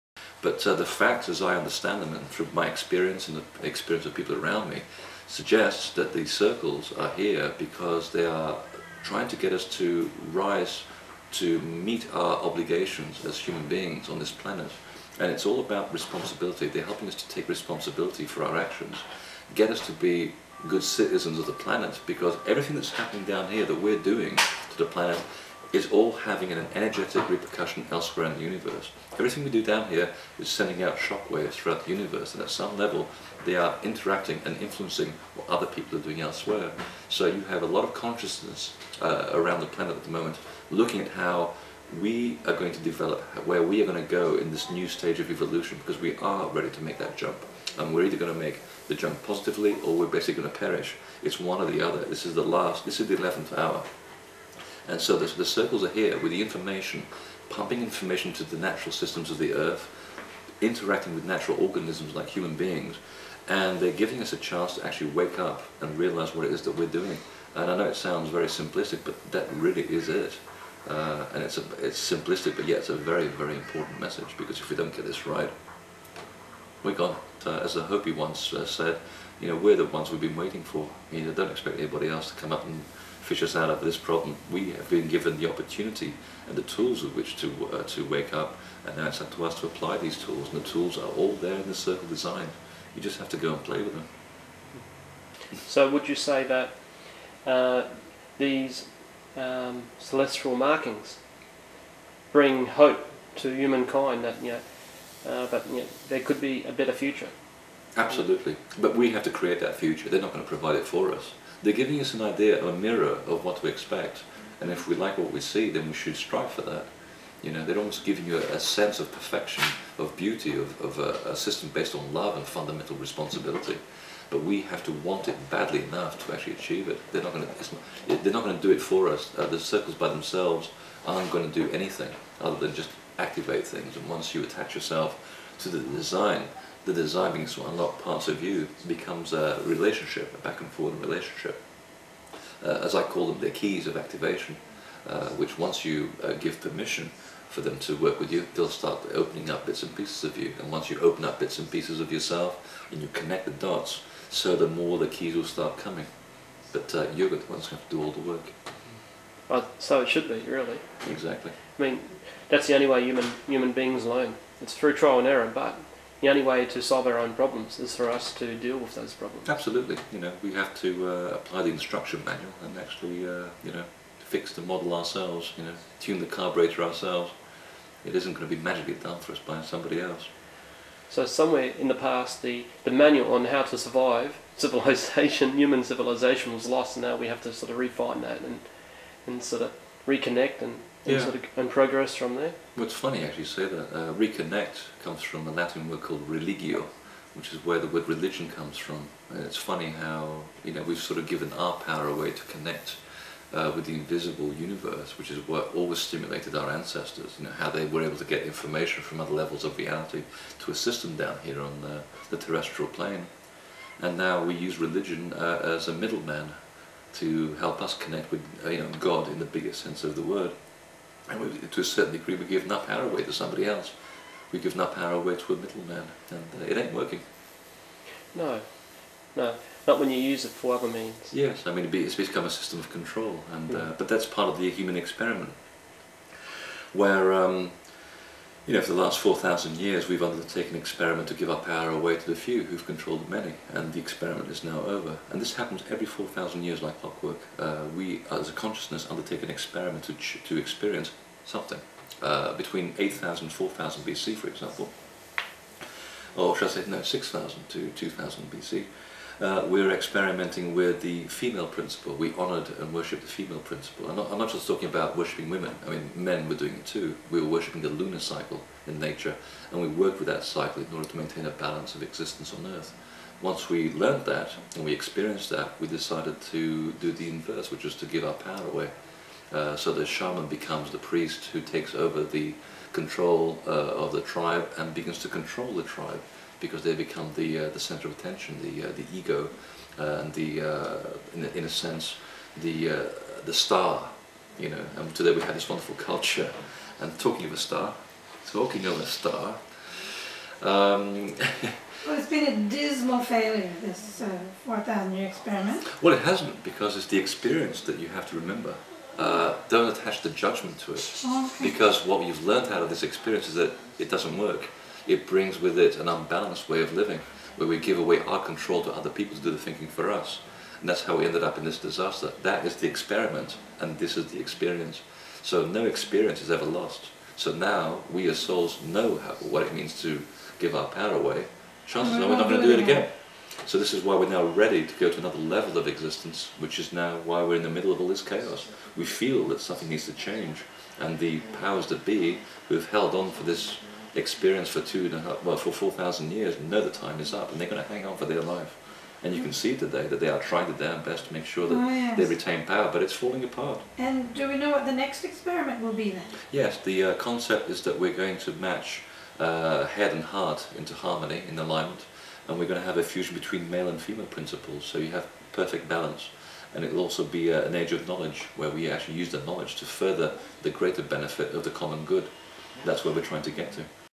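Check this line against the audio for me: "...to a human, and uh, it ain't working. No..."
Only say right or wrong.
wrong.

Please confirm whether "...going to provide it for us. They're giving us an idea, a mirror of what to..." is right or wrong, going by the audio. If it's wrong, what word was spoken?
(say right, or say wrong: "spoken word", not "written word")
right.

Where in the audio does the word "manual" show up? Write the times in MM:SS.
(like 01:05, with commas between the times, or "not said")
02:52, 03:02.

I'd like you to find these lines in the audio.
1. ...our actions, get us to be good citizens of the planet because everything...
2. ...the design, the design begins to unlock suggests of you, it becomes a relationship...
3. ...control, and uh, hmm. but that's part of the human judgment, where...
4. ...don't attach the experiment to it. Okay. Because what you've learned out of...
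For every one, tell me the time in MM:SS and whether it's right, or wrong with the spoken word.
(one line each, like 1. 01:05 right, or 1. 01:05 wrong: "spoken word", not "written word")
1. 00:18 right
2. 02:15 wrong: "parts", not "suggests"
3. 03:52 wrong: "experiment", not "judgment"
4. 05:09 wrong: "judgment", not "experiment".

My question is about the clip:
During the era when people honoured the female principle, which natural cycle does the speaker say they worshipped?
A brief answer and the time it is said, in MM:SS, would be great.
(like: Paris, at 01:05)
lunar cycle, at 04:27.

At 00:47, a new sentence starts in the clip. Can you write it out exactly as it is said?
And we're either going to make the jump positively, or we're basically going to perish.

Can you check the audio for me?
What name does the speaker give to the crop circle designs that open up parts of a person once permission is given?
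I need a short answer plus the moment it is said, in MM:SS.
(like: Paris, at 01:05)
keys of activation, at 02:23.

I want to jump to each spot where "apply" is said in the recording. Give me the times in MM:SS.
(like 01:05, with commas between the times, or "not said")
01:29, 02:51.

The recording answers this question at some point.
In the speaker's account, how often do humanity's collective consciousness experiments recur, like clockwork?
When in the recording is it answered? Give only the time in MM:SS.
04:05.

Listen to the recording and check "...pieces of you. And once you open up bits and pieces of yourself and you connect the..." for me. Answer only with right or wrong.
right.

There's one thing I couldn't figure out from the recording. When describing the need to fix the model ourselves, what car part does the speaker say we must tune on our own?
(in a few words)
carburetor.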